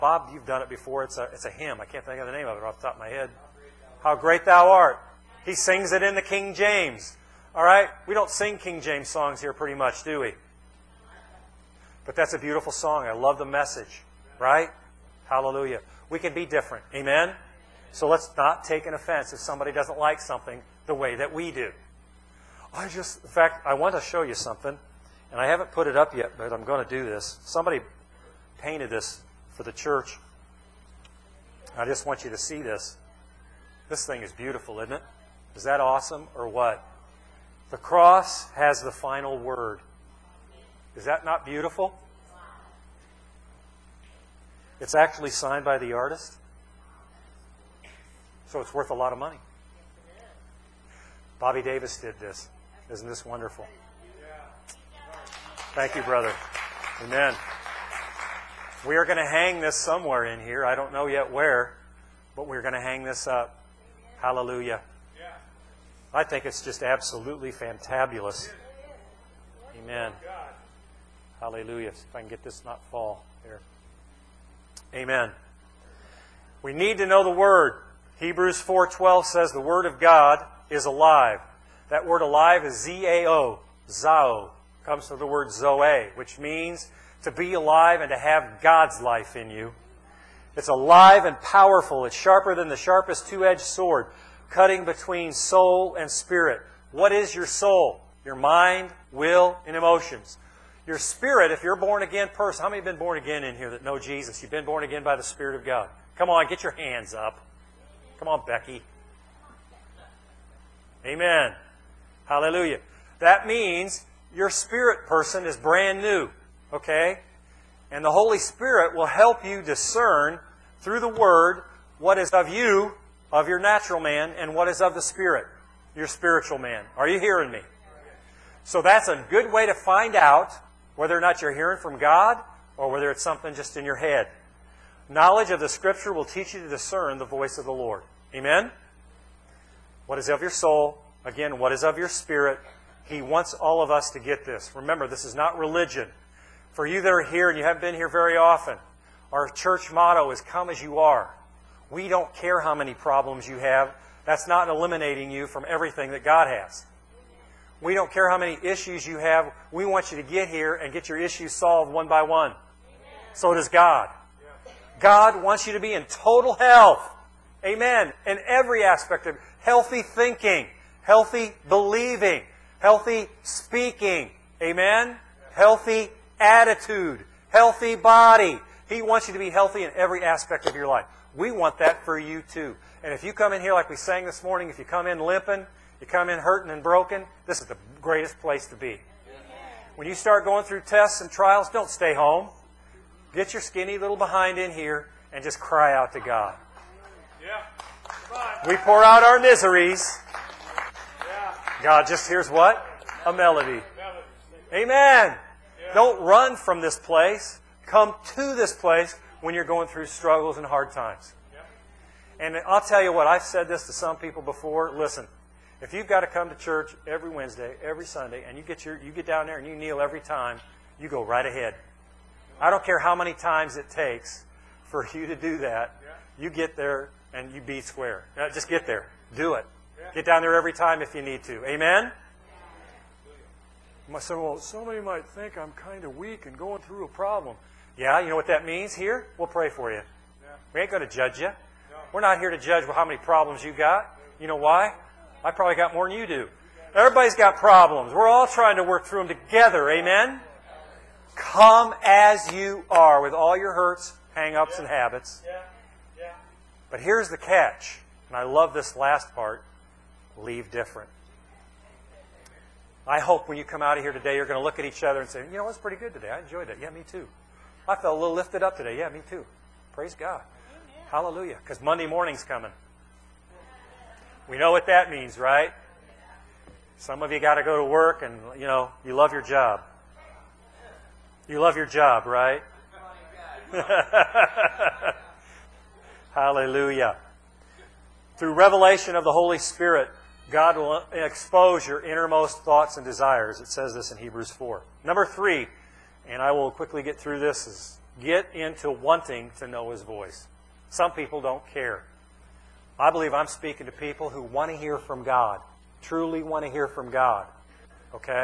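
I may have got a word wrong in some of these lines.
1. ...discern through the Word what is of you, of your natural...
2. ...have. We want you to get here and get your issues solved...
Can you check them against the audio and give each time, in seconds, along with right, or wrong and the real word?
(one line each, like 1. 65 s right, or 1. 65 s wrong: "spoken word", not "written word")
1. 119 s right
2. 159 s right.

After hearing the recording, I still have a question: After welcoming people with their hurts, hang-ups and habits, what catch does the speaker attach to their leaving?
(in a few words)
Leave different.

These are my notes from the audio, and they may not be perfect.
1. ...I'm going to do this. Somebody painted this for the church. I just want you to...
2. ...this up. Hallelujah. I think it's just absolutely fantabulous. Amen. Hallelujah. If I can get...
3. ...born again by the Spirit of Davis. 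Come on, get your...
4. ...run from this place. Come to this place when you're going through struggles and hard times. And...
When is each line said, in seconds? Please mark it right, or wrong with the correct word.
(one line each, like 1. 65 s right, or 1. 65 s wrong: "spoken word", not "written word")
1. 26 s right
2. 63 s right
3. 104 s wrong: "God", not "Davis"
4. 206 s right.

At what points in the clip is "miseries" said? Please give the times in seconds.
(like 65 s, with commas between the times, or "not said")
199 s.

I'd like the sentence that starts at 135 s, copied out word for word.
Knowledge of the Scripture will teach you to discern the voice of the Lord.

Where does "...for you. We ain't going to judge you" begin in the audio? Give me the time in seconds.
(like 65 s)
239 s.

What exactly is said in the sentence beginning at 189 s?
When you start going through tests and trials, don't stay home.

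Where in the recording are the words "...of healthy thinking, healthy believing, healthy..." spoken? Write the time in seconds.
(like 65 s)
169 s.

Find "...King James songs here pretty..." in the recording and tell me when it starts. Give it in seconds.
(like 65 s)
8 s.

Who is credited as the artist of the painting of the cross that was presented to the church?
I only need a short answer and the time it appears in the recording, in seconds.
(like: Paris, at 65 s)
Bobby Davis, at 51 s.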